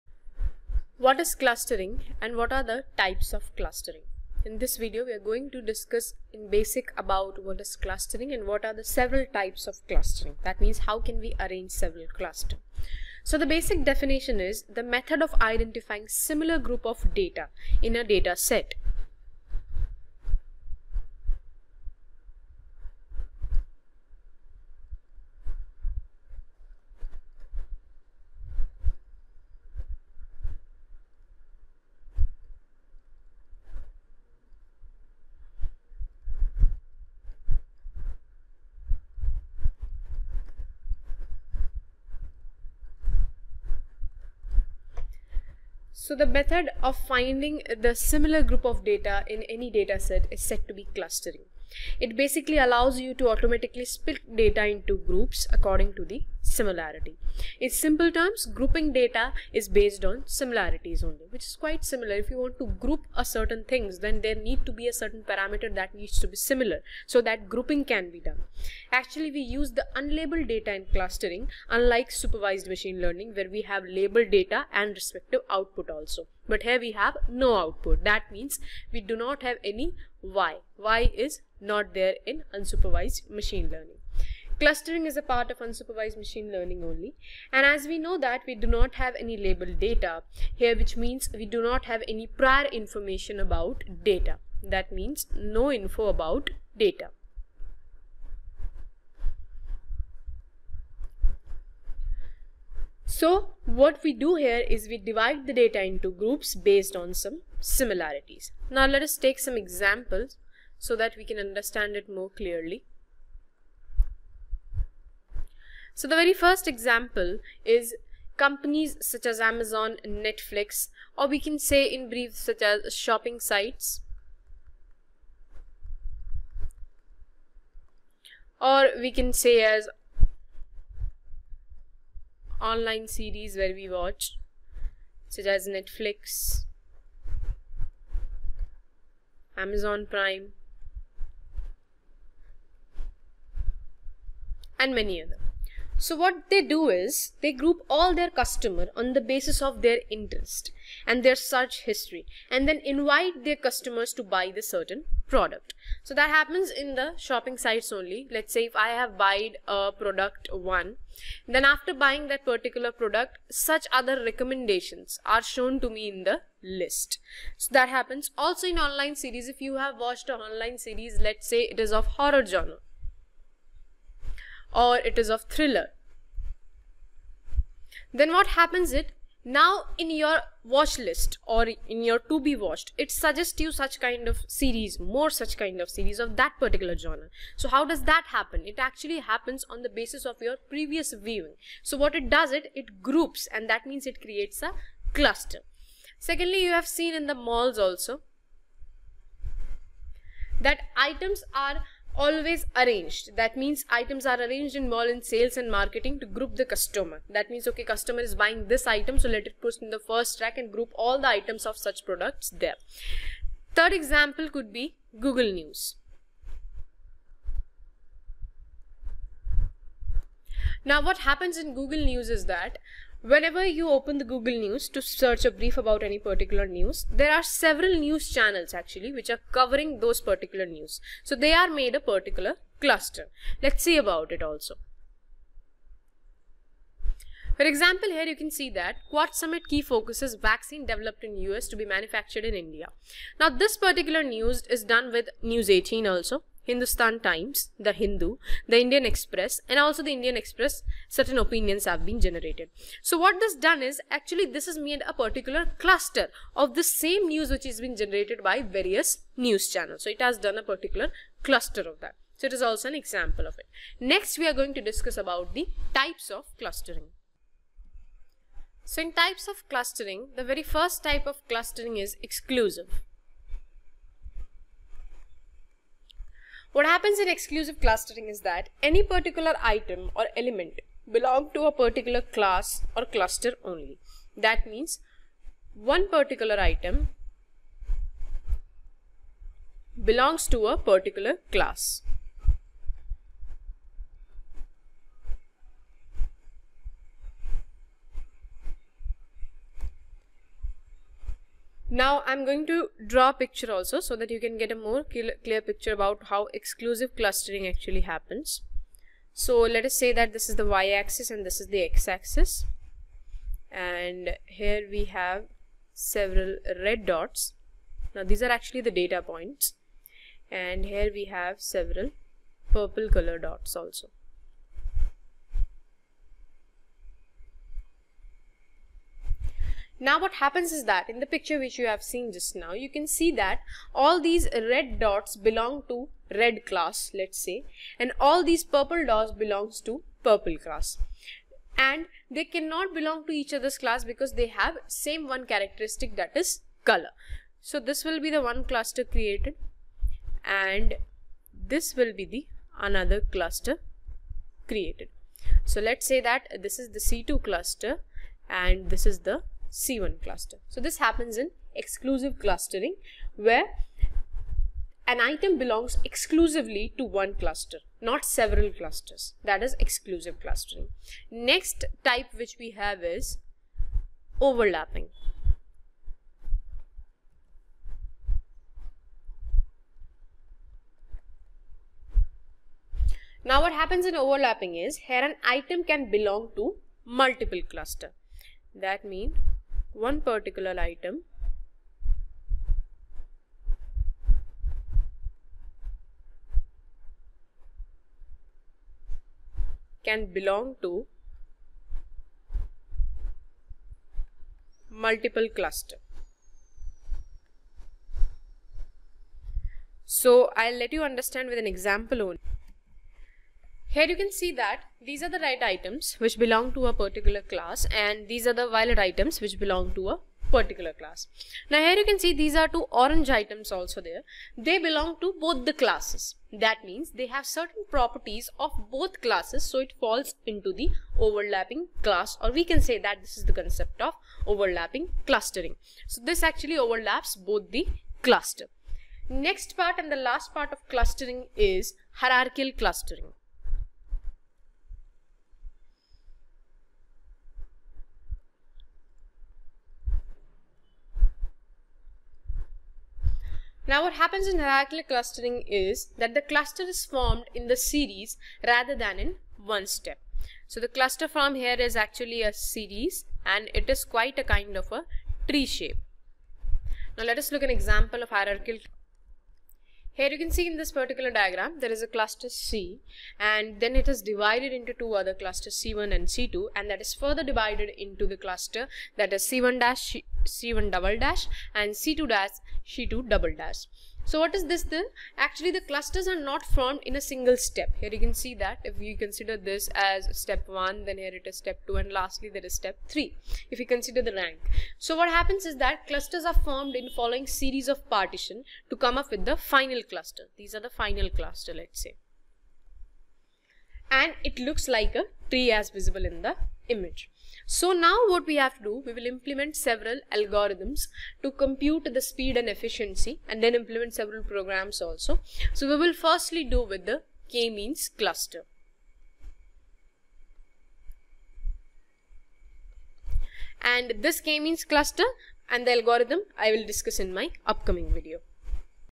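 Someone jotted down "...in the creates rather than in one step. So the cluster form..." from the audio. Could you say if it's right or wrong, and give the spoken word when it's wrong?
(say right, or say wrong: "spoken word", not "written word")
wrong: "series", not "creates".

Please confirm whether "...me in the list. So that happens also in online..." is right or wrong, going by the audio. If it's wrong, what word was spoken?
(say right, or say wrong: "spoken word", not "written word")
right.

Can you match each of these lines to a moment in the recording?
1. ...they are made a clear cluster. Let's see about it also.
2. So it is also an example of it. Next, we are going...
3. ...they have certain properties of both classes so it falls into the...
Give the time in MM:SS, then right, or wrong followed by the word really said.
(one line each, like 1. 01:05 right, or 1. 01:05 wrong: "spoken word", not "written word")
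1. 03:51 wrong: "particular", not "clear"
2. 04:22 right
3. 07:07 right.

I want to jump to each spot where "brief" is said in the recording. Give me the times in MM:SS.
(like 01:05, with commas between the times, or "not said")
02:02, 03:45.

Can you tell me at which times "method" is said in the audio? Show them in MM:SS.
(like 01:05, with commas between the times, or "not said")
00:14, 00:46.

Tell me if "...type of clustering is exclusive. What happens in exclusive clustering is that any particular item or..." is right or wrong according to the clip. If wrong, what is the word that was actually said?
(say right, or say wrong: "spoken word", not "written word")
right.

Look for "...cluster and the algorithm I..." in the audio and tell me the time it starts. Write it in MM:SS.
08:44.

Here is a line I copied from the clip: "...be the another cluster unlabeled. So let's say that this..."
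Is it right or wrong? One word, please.
wrong.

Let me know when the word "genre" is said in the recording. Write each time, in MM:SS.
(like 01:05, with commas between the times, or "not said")
02:52, 03:06.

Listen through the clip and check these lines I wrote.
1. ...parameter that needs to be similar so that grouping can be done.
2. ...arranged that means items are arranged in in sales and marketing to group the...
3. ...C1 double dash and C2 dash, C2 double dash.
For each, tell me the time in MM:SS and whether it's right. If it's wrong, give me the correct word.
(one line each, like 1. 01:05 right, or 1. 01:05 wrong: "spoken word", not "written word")
1. 01:05 right
2. 03:22 right
3. 08:00 right.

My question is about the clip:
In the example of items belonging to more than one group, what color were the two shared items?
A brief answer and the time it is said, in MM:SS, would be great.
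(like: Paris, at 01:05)
Orange, at 07:02.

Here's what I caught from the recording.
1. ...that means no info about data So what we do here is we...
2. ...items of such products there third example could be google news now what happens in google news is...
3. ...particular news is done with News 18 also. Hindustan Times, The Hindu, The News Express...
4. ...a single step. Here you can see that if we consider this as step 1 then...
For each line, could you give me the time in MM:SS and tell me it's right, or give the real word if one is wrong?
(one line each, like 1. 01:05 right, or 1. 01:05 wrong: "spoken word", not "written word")
1. 01:34 right
2. 03:31 right
3. 04:03 wrong: "Indian", not "News"
4. 08:07 right.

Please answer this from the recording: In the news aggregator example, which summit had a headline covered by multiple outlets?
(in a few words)
Quad Summit.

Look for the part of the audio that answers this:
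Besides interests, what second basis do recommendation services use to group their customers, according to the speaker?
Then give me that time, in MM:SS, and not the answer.
02:31.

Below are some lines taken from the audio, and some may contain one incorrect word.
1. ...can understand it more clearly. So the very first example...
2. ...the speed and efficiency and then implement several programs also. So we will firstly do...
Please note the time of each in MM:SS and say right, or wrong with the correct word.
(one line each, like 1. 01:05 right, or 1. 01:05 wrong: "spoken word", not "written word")
1. 01:51 right
2. 08:32 right.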